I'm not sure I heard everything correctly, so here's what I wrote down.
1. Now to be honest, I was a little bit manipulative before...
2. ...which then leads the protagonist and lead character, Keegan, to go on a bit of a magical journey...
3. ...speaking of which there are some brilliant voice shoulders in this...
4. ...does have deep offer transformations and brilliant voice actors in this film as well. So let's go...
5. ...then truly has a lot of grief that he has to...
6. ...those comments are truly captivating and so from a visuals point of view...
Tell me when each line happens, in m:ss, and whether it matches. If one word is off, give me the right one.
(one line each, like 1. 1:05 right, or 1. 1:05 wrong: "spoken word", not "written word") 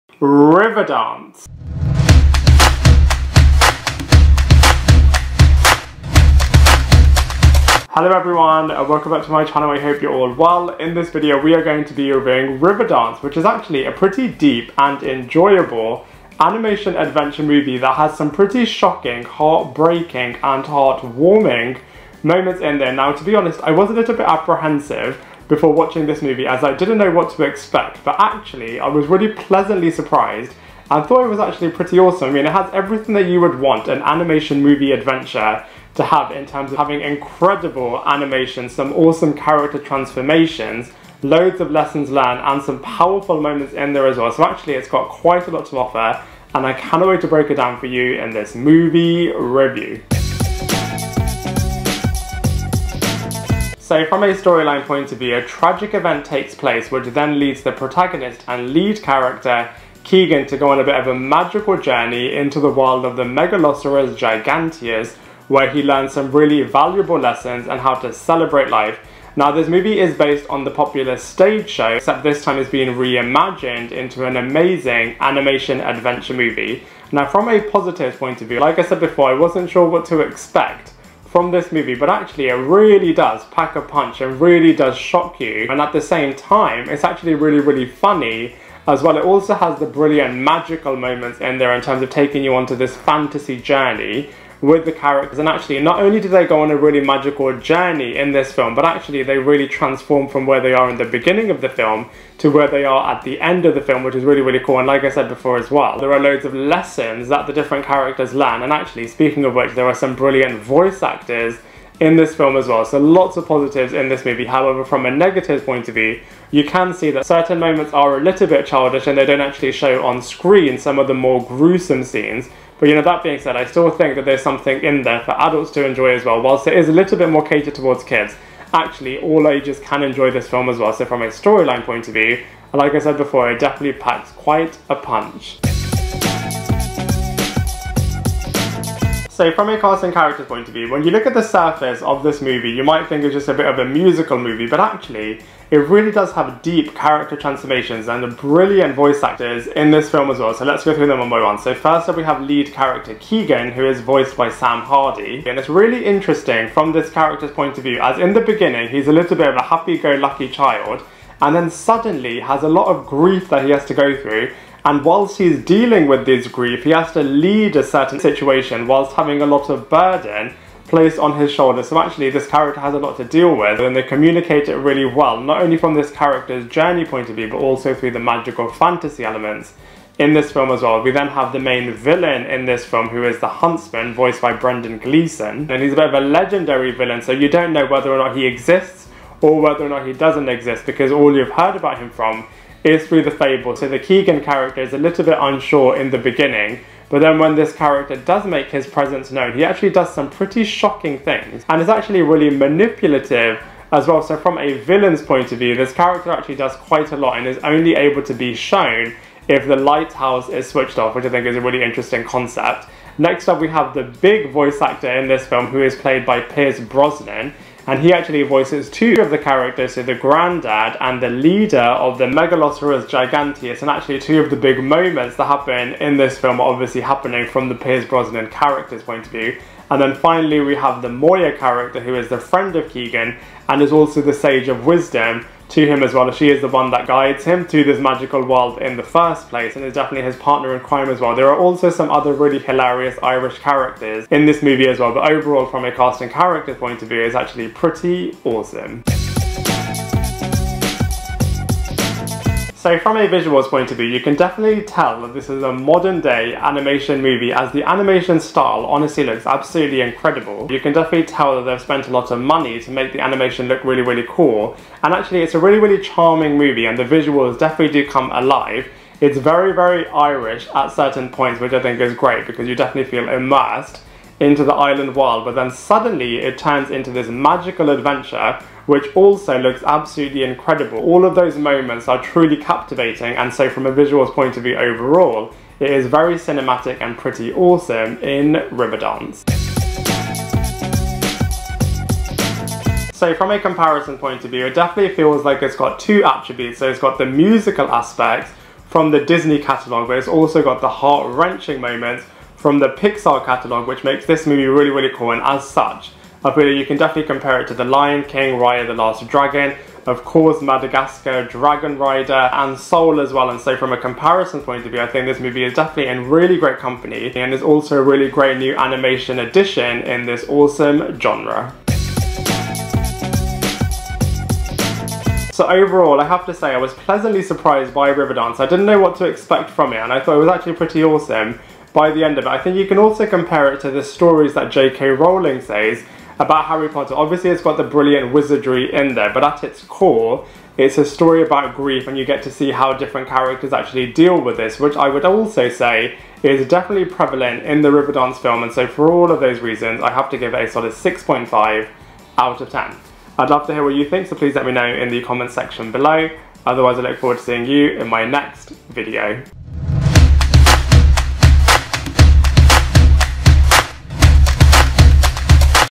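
1. 0:22 wrong: "apprehensive", not "manipulative"
2. 0:56 right
3. 1:49 wrong: "actors", not "shoulders"
4. 2:26 wrong: "character", not "offer"
5. 2:41 wrong: "suddenly", not "truly"
6. 4:41 wrong: "moments", not "comments".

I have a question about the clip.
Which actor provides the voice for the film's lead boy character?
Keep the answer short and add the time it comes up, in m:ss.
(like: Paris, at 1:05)
Sam Hardy, at 2:34.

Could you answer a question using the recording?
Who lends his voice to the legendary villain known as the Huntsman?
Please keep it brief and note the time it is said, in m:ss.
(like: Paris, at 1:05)
Brendan Gleeson, at 3:04.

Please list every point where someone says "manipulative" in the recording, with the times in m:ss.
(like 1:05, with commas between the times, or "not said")
3:22.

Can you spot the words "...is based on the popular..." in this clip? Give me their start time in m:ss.
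1:09.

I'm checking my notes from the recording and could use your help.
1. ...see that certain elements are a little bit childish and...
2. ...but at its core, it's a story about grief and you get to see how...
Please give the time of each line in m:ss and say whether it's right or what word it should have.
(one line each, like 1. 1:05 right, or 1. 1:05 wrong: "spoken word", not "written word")
1. 1:56 wrong: "moments", not "elements"
2. 5:39 right.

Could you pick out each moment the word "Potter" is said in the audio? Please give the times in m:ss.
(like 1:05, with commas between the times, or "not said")
5:36.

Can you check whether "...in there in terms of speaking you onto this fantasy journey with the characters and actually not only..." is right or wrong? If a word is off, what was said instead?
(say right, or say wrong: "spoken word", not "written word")
wrong: "taking", not "speaking".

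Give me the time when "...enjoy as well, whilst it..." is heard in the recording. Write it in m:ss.
2:05.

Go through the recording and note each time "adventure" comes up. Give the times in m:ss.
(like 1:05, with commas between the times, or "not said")
0:16, 0:34, 1:15, 4:37.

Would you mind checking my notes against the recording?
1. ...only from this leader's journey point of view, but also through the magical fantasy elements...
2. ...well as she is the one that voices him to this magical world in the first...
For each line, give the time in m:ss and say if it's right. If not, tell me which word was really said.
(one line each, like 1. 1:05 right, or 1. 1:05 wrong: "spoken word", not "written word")
1. 2:55 wrong: "character", not "leader"
2. 3:56 wrong: "guides", not "voices".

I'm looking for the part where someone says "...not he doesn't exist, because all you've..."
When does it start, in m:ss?
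3:09.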